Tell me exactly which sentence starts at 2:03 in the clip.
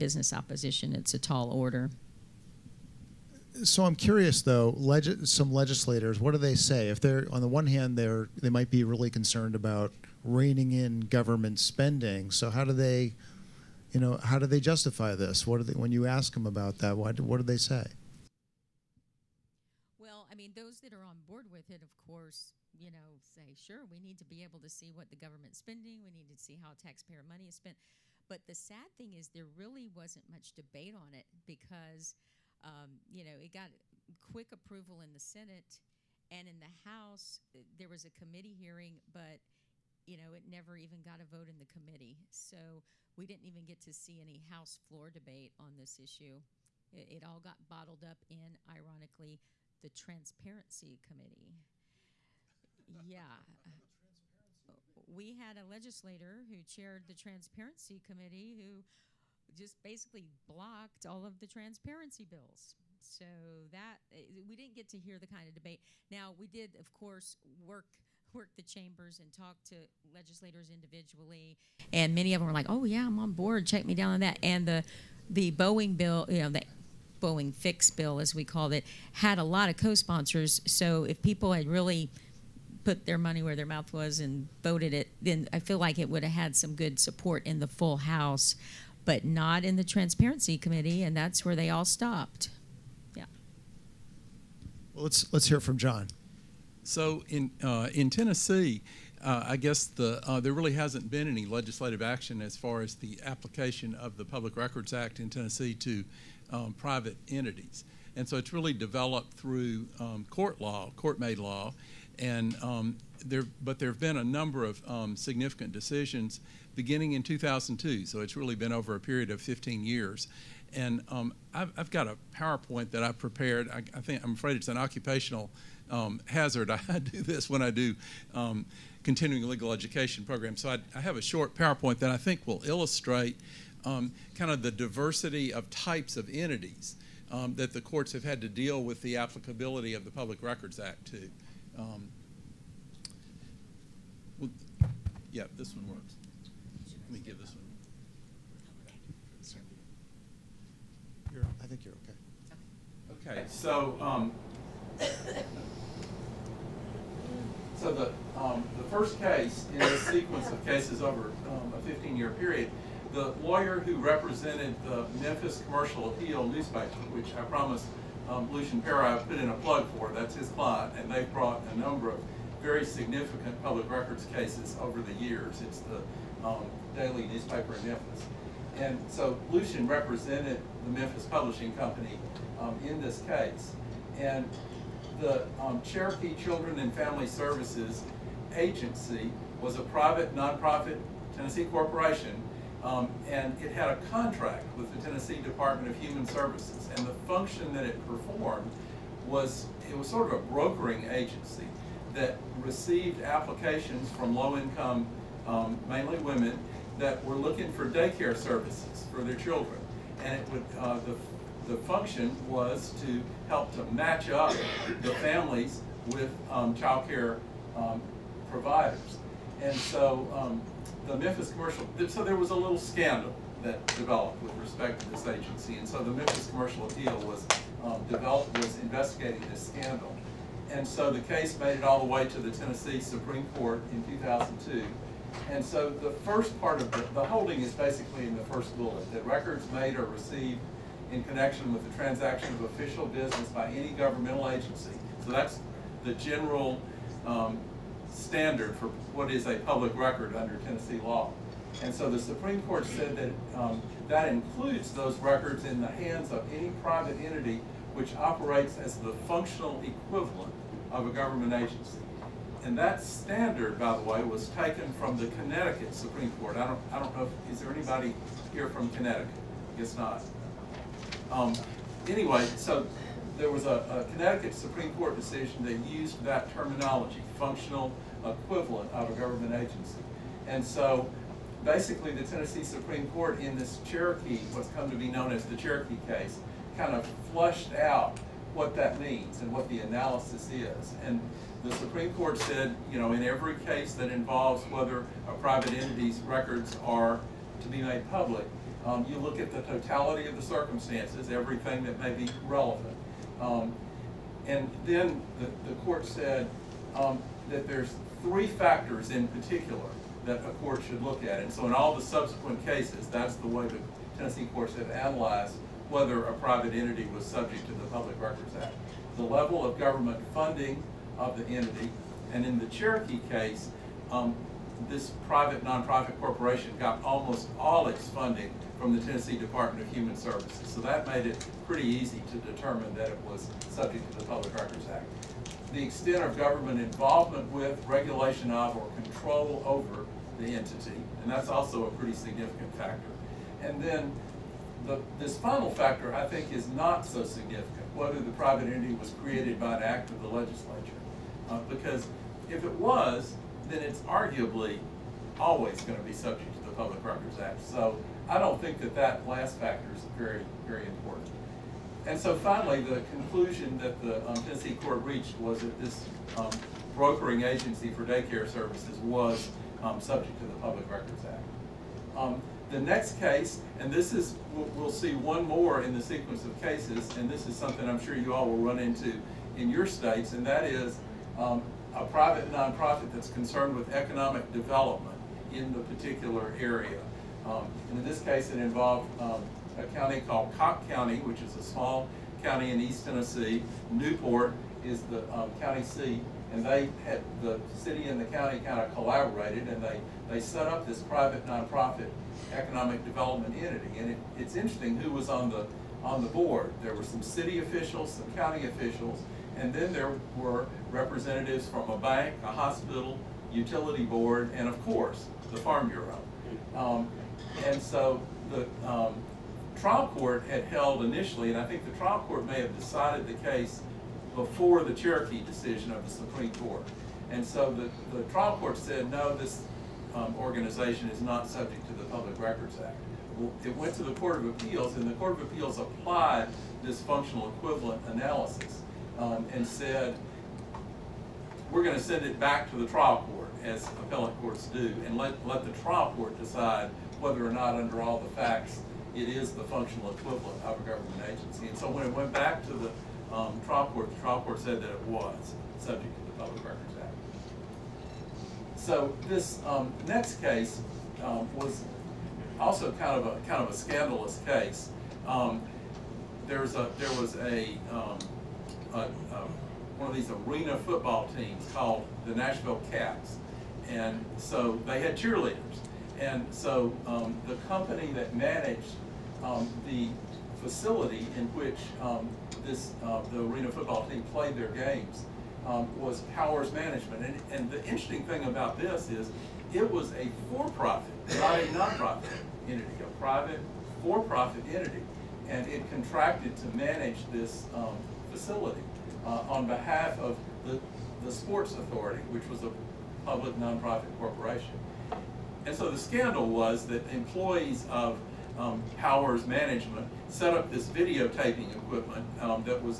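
I, I think I'm afraid it's an occupational um, hazard.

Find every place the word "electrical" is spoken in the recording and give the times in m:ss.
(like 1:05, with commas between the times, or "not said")
not said.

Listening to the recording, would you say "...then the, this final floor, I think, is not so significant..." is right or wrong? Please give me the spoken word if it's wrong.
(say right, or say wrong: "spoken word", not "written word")
wrong: "factor", not "floor".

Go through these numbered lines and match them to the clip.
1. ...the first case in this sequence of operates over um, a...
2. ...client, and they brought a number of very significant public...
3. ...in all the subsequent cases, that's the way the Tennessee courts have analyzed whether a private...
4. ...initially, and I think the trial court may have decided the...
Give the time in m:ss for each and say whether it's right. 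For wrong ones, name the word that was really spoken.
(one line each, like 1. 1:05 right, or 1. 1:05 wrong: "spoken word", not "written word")
1. 2:38 wrong: "cases", not "operates"
2. 2:50 right
3. 5:11 right
4. 7:01 right.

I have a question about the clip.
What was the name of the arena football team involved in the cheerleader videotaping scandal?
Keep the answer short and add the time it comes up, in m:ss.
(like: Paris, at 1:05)
Nashville Kats, at 7:52.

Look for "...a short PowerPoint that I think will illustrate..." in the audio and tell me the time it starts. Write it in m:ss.
2:11.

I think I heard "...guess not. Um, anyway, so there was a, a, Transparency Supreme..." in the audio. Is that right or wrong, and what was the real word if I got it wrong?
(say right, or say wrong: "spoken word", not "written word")
wrong: "Connecticut", not "Transparency".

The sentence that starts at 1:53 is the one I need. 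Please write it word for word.
But there have been a number of um, significant decisions beginning in 2002.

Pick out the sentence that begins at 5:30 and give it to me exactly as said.
So that made it pretty easy to determine that it was subject to the Public Records Act.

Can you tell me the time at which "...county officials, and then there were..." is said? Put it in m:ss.
6:48.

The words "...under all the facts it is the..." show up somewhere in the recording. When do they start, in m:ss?
7:27.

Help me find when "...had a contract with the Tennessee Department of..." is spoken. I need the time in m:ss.
3:13.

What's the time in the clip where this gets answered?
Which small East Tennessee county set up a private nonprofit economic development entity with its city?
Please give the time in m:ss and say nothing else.
6:30.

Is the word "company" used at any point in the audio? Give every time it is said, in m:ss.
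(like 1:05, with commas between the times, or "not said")
3:01, 7:57.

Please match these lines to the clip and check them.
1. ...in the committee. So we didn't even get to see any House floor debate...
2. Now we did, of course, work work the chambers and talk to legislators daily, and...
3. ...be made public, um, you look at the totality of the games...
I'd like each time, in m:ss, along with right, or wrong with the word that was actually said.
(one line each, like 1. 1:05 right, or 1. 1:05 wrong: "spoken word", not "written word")
1. 0:41 right
2. 1:06 wrong: "individually", not "daily"
3. 4:57 wrong: "circumstances", not "games".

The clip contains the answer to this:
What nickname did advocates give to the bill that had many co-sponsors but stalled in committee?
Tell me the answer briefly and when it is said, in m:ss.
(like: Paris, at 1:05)
Boeing fix bill, at 1:16.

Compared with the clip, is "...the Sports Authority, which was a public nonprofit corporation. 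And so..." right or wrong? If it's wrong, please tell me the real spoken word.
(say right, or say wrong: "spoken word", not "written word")
right.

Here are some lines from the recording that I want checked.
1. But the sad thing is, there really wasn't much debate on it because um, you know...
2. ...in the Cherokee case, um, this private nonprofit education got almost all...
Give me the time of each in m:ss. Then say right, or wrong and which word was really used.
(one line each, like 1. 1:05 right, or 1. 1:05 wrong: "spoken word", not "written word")
1. 0:28 right
2. 5:22 wrong: "corporation", not "education".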